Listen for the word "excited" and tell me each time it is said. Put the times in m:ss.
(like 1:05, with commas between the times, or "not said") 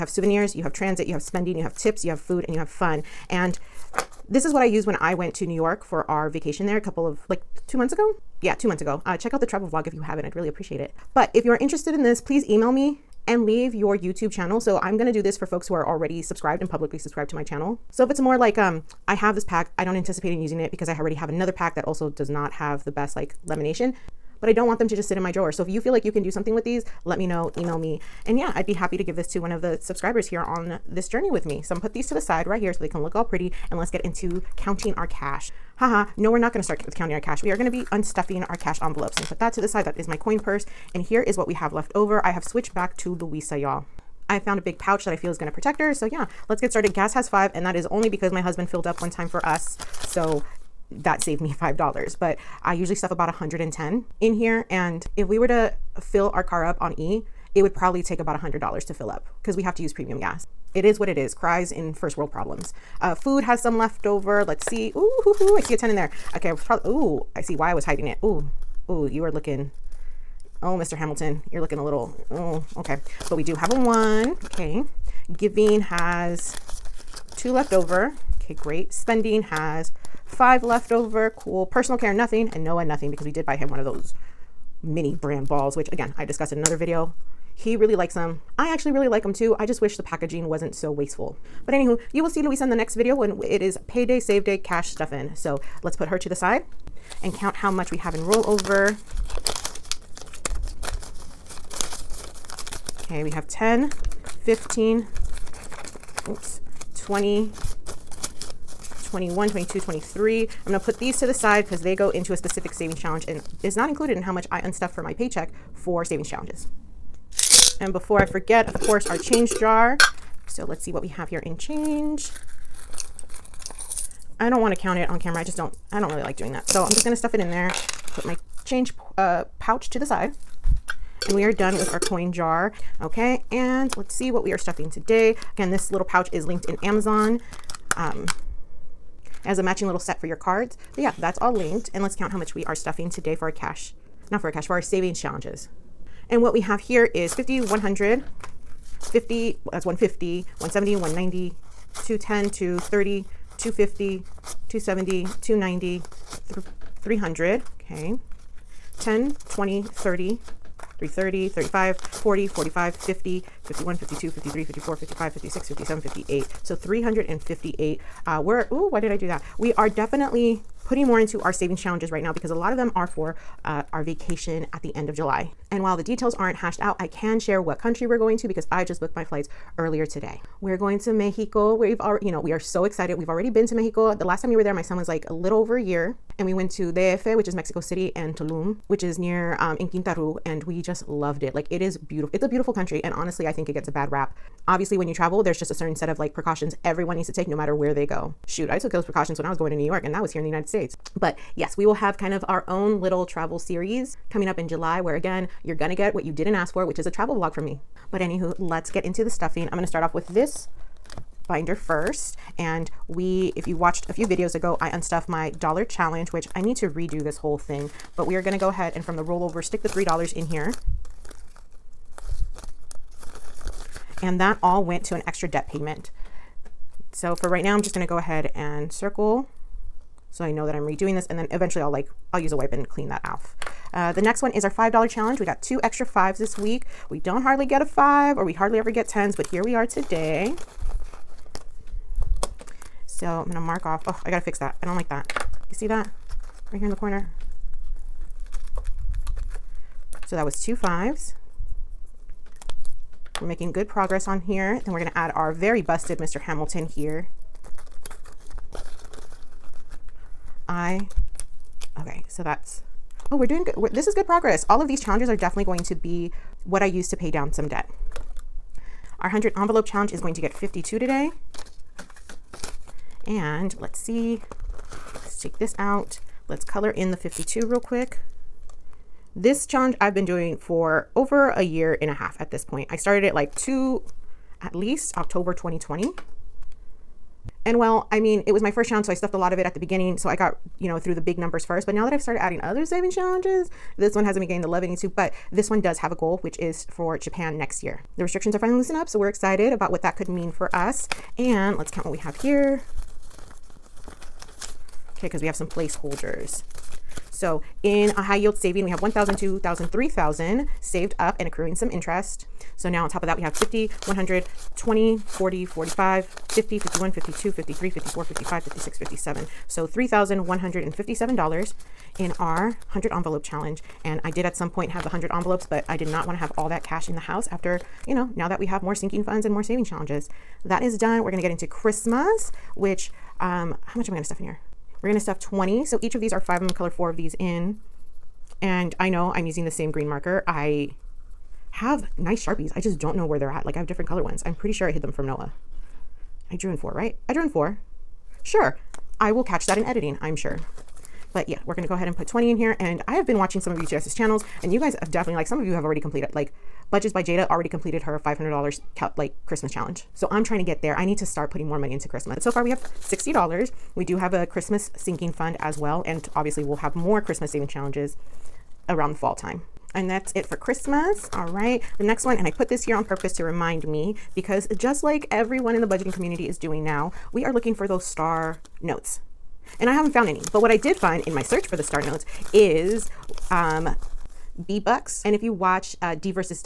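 3:02, 4:59.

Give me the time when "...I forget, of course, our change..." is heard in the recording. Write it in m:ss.
1:58.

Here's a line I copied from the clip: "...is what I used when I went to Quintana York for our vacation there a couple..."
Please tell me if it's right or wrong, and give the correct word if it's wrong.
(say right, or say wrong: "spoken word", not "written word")
wrong: "New", not "Quintana".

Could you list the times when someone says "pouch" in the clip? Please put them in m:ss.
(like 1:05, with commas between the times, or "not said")
0:44, 2:09, 2:16.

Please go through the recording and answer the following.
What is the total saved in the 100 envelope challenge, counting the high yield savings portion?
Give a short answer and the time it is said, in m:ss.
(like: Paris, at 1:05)
$3,157, at 5:19.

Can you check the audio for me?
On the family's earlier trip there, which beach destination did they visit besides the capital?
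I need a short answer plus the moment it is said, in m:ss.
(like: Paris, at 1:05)
Tulum, at 3:08.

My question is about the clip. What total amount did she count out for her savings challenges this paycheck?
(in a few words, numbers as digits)
358.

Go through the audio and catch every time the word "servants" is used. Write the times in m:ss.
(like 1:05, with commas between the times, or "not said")
not said.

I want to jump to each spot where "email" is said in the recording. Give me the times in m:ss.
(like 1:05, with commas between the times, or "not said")
0:12, 0:27.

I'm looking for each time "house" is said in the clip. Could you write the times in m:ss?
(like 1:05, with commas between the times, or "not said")
5:27.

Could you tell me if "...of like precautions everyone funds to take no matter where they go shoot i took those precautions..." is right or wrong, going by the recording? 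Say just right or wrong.
wrong.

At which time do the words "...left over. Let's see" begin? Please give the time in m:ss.
1:03.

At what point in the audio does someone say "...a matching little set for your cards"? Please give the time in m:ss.
2:19.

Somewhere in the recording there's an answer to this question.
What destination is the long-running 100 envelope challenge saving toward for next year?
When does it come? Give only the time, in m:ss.
4:57.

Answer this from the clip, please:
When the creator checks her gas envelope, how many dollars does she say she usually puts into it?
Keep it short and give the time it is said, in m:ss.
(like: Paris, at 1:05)
110, at 0:53.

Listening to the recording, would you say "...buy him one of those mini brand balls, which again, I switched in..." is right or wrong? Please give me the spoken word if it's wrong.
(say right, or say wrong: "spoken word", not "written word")
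wrong: "discussed", not "switched".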